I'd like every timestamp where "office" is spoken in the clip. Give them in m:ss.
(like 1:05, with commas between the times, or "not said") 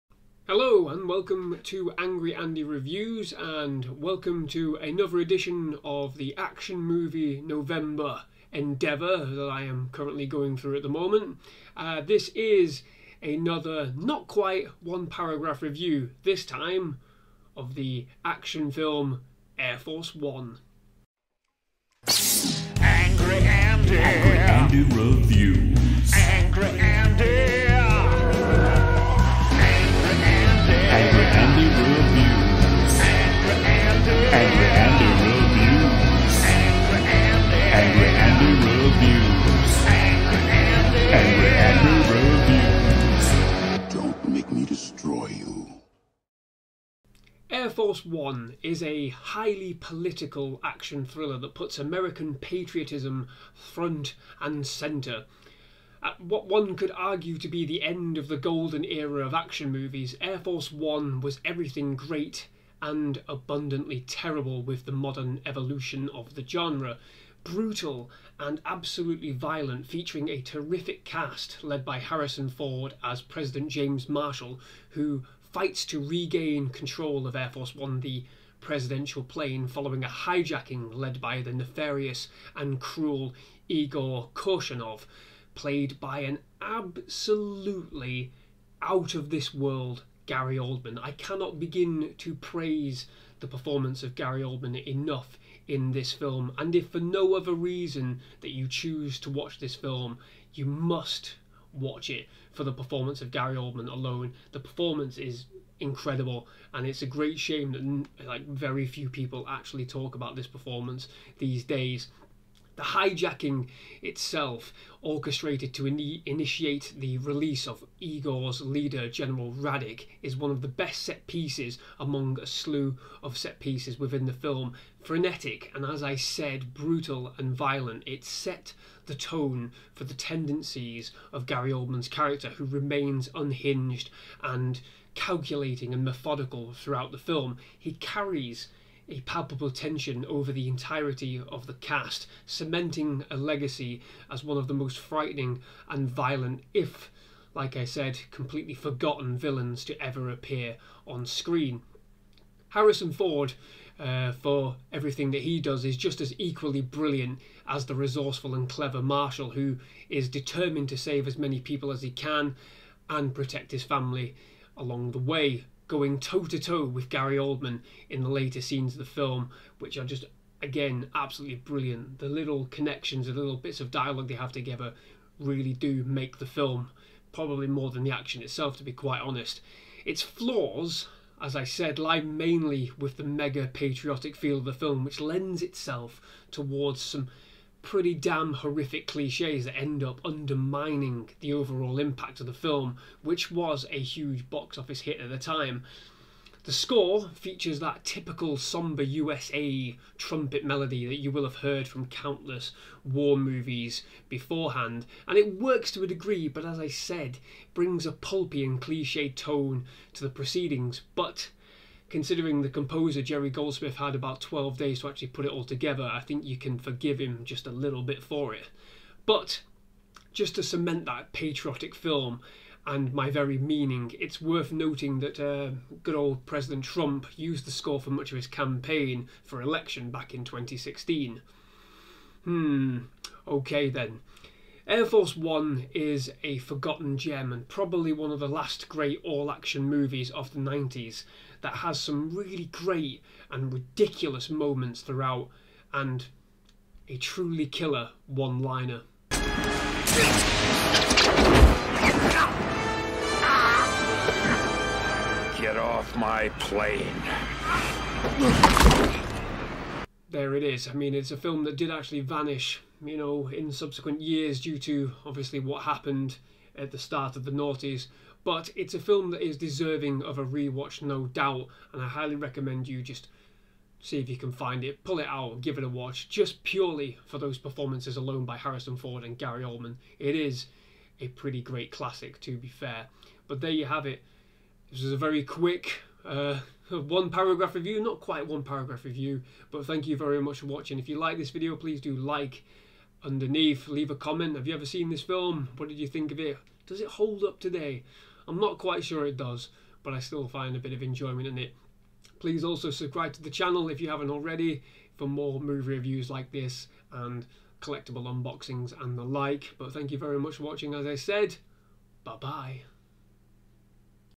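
3:14.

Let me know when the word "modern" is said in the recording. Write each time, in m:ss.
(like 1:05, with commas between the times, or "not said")
1:04.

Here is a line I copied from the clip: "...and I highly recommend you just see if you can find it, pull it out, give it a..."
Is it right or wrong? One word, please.
right.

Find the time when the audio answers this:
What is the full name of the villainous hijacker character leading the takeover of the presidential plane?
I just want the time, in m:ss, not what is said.
1:23.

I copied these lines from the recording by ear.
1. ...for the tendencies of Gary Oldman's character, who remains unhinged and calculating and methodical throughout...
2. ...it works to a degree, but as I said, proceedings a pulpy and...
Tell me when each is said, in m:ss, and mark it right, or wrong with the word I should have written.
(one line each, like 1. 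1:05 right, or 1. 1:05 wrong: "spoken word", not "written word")
1. 2:09 right
2. 3:25 wrong: "brings", not "proceedings".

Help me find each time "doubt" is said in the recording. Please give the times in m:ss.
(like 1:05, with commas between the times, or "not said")
4:31.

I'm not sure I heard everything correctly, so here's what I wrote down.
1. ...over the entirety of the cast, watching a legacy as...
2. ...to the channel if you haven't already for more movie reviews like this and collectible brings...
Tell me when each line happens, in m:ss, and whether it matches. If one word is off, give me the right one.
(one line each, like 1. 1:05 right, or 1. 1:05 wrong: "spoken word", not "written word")
1. 2:20 wrong: "cementing", not "watching"
2. 5:03 wrong: "unboxings", not "brings".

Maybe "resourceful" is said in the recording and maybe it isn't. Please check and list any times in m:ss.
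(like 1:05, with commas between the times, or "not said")
2:37.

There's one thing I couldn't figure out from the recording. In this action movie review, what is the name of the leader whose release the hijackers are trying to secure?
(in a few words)
General Radek.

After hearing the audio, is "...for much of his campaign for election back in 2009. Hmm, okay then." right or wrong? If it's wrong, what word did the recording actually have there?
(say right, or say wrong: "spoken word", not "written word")
wrong: "2016", not "2009".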